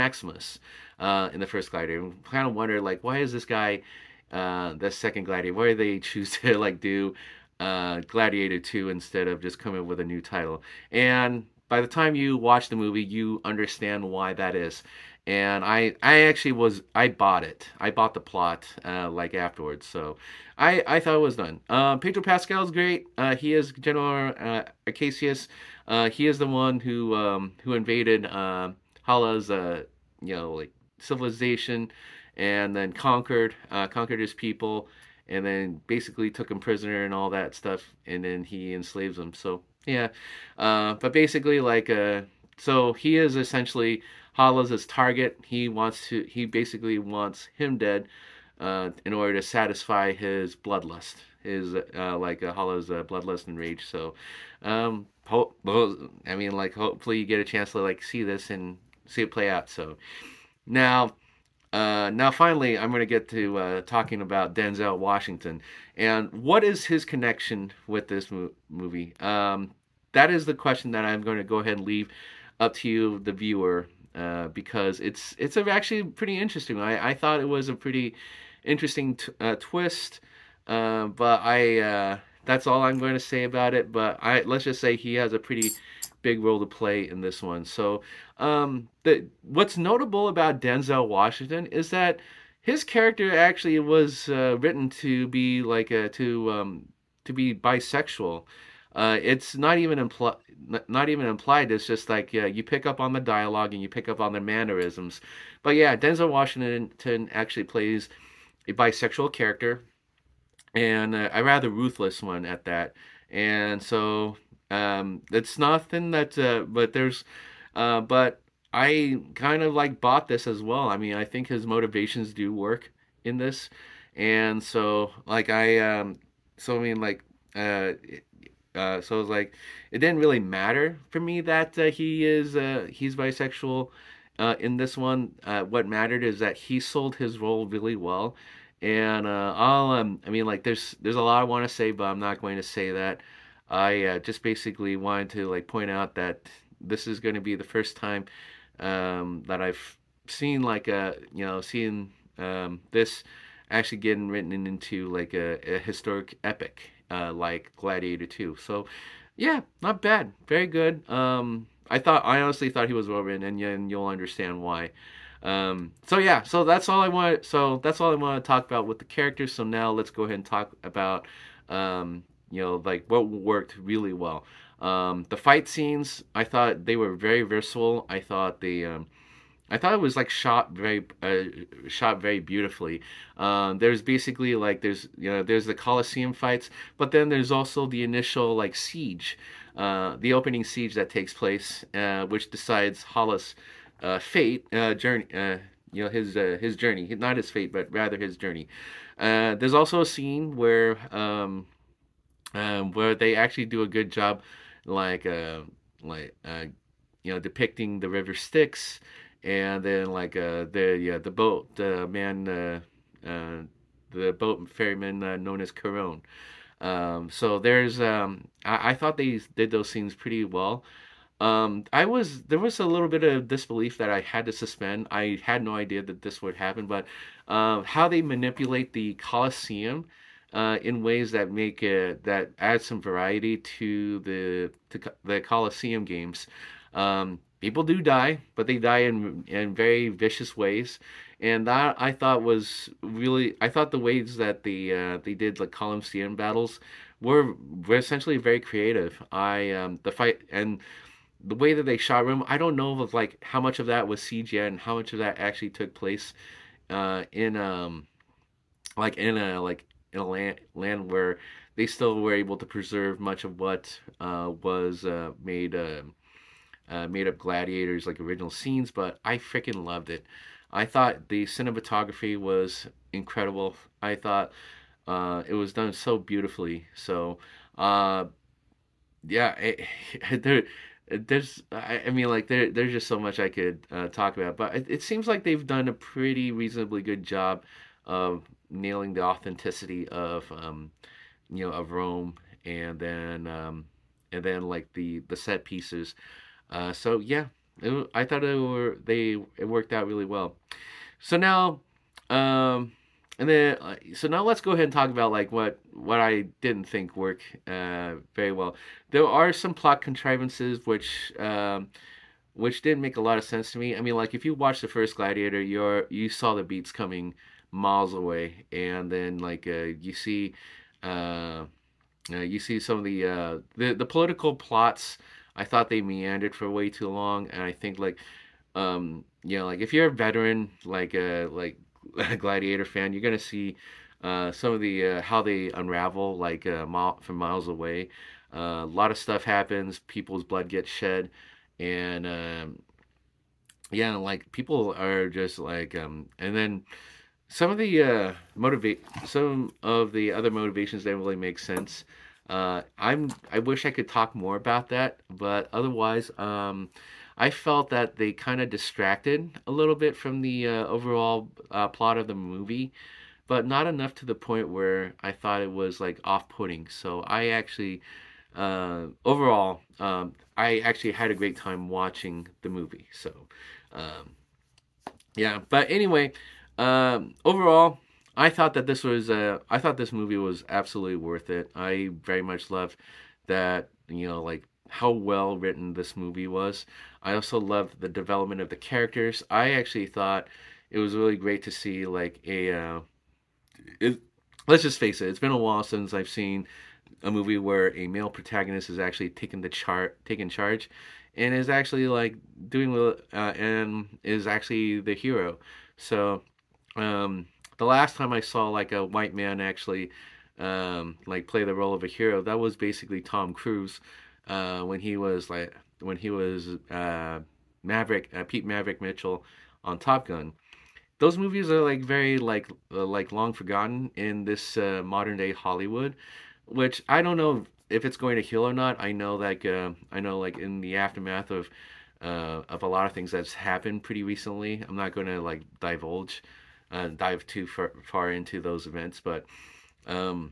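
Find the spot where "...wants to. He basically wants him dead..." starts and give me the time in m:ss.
0:45.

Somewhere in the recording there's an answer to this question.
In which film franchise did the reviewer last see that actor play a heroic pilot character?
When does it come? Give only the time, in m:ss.
6:59.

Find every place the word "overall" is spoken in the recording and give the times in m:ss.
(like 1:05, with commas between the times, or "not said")
6:00, 6:09, 6:17.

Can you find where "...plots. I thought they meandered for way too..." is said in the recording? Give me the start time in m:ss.
5:24.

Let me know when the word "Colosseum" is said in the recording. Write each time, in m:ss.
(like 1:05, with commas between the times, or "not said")
3:05, 3:49.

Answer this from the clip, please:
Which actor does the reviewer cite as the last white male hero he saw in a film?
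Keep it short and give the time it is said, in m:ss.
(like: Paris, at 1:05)
Tom Cruise, at 6:53.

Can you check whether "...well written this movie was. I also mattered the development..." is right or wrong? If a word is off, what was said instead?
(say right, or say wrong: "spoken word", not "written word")
wrong: "loved", not "mattered".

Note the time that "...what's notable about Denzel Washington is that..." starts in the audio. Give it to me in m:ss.
1:29.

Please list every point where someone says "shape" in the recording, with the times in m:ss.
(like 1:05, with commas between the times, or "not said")
not said.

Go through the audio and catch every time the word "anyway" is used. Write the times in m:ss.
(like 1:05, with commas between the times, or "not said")
6:15.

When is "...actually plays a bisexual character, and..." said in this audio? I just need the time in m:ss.
1:47.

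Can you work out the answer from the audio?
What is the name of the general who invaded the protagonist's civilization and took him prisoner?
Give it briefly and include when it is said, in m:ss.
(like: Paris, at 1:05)
Acacius, at 0:24.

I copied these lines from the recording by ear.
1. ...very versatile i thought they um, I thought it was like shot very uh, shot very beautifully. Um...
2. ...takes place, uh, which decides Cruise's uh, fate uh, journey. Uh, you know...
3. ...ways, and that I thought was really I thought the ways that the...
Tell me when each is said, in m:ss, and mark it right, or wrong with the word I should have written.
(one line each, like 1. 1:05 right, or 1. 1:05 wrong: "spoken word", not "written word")
1. 2:57 right
2. 3:11 wrong: "Hala", not "Cruise"
3. 4:00 right.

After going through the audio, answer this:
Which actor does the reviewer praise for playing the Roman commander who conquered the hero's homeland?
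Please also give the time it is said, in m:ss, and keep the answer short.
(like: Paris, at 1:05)
Pedro Pascal, at 0:21.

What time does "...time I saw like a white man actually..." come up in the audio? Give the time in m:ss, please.
6:48.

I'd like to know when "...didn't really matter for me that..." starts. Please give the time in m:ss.
2:09.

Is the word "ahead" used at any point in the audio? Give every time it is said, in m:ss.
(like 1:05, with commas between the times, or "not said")
1:11, 2:50, 5:04.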